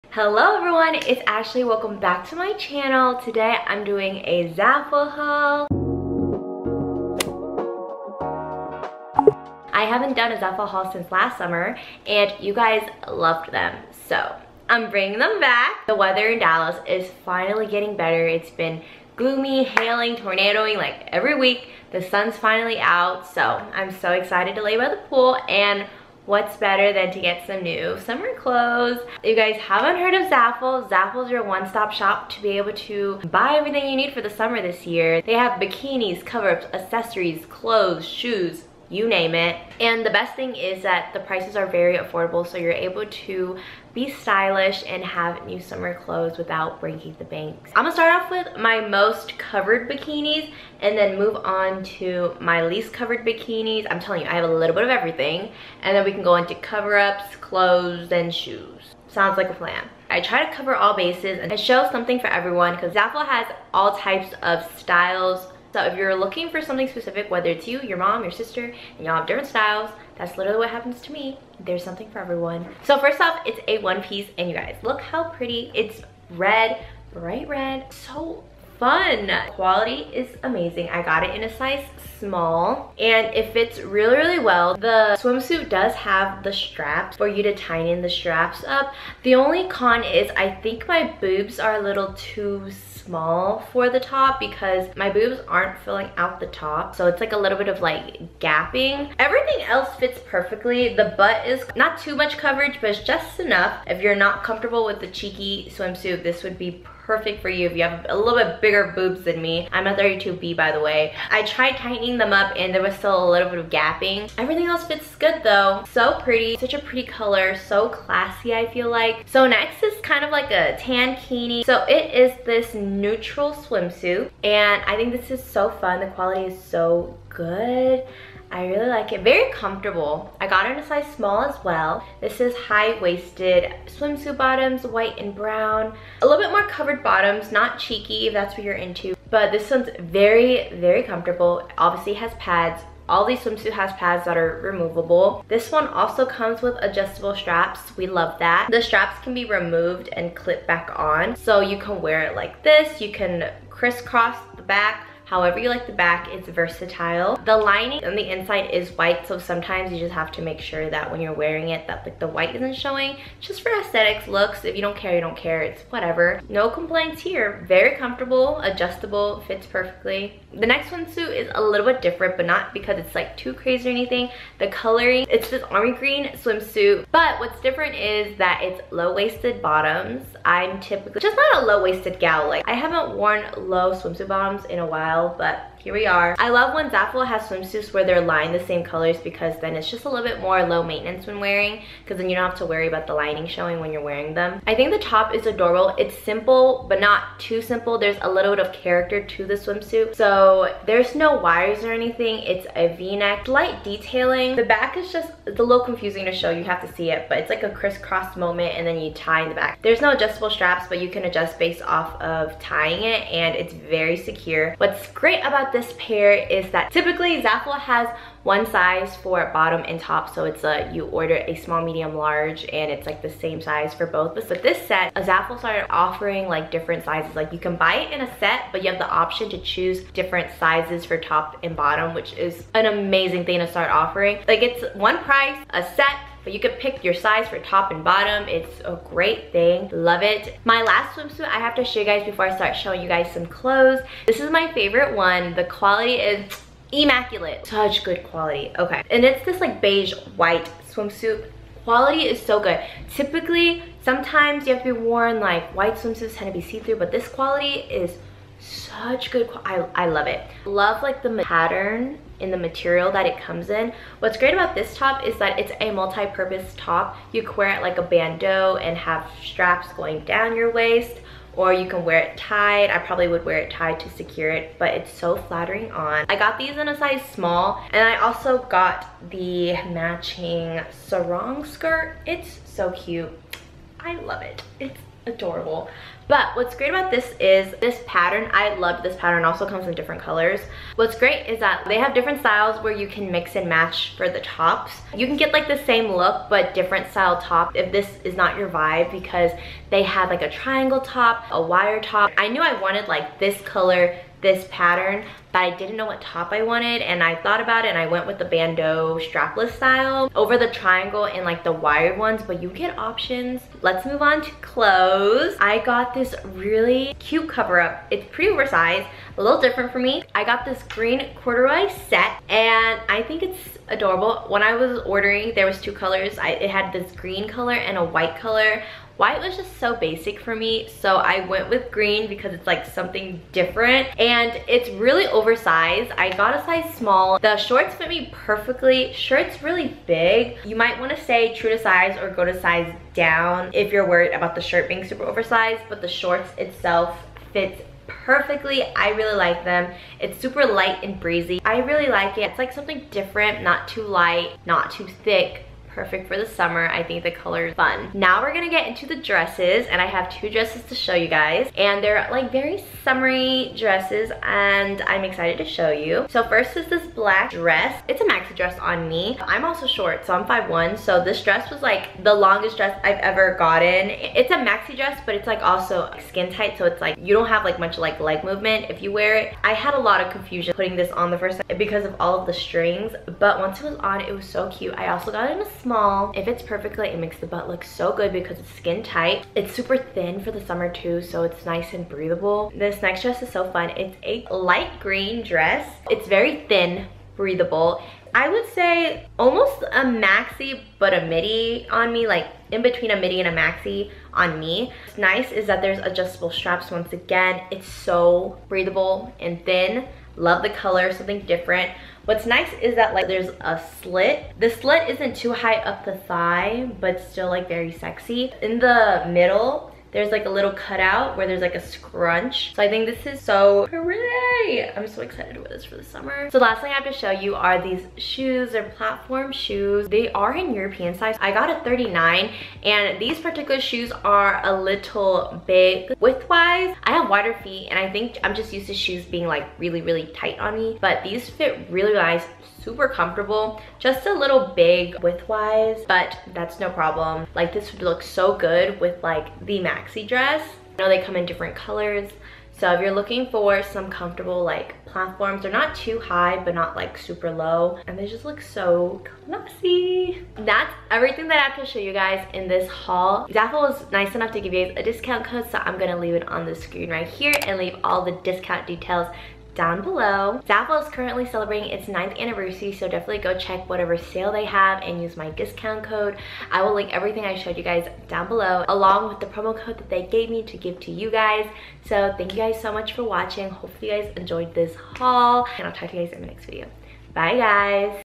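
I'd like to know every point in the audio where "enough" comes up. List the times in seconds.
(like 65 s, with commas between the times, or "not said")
103 s, 464 s.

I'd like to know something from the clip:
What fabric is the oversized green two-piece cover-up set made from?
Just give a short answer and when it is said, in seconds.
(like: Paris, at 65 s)
corduroy, at 321 s.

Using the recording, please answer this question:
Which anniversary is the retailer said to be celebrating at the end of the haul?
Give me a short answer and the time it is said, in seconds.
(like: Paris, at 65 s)
9th, at 472 s.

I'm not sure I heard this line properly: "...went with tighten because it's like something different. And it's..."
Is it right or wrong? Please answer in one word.
wrong.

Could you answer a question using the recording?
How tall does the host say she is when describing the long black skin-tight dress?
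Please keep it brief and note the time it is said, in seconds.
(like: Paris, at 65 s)
5'1, at 370 s.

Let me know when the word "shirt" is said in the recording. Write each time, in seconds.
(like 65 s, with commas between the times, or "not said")
339 s, 344 s.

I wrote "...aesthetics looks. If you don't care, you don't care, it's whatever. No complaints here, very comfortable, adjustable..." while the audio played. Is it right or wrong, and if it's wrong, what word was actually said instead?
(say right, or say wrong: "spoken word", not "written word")
right.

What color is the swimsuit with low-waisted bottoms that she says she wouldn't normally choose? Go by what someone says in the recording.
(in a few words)
army green.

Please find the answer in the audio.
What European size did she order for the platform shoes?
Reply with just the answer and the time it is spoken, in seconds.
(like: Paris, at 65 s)
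39, at 431 s.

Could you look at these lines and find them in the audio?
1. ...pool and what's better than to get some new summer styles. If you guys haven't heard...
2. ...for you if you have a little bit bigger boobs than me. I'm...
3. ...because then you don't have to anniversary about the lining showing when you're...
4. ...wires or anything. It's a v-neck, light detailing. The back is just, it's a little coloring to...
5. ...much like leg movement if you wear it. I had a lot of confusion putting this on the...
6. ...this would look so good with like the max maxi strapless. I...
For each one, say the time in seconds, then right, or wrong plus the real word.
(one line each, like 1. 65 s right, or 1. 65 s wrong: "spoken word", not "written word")
1. 25 s wrong: "clothes", not "styles"
2. 107 s right
3. 192 s wrong: "worry", not "anniversary"
4. 201 s wrong: "confusing", not "coloring"
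5. 377 s right
6. 447 s wrong: "dress", not "strapless".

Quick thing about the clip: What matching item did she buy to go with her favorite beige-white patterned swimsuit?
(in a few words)
sarong skirt.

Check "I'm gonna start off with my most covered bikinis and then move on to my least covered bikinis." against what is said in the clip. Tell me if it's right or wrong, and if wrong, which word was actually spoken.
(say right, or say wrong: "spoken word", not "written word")
right.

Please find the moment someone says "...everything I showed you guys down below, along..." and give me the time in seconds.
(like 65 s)
477 s.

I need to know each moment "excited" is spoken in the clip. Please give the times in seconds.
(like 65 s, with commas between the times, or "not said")
24 s, 365 s, 425 s.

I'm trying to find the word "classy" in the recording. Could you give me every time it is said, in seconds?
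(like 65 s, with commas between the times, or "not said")
117 s, 459 s.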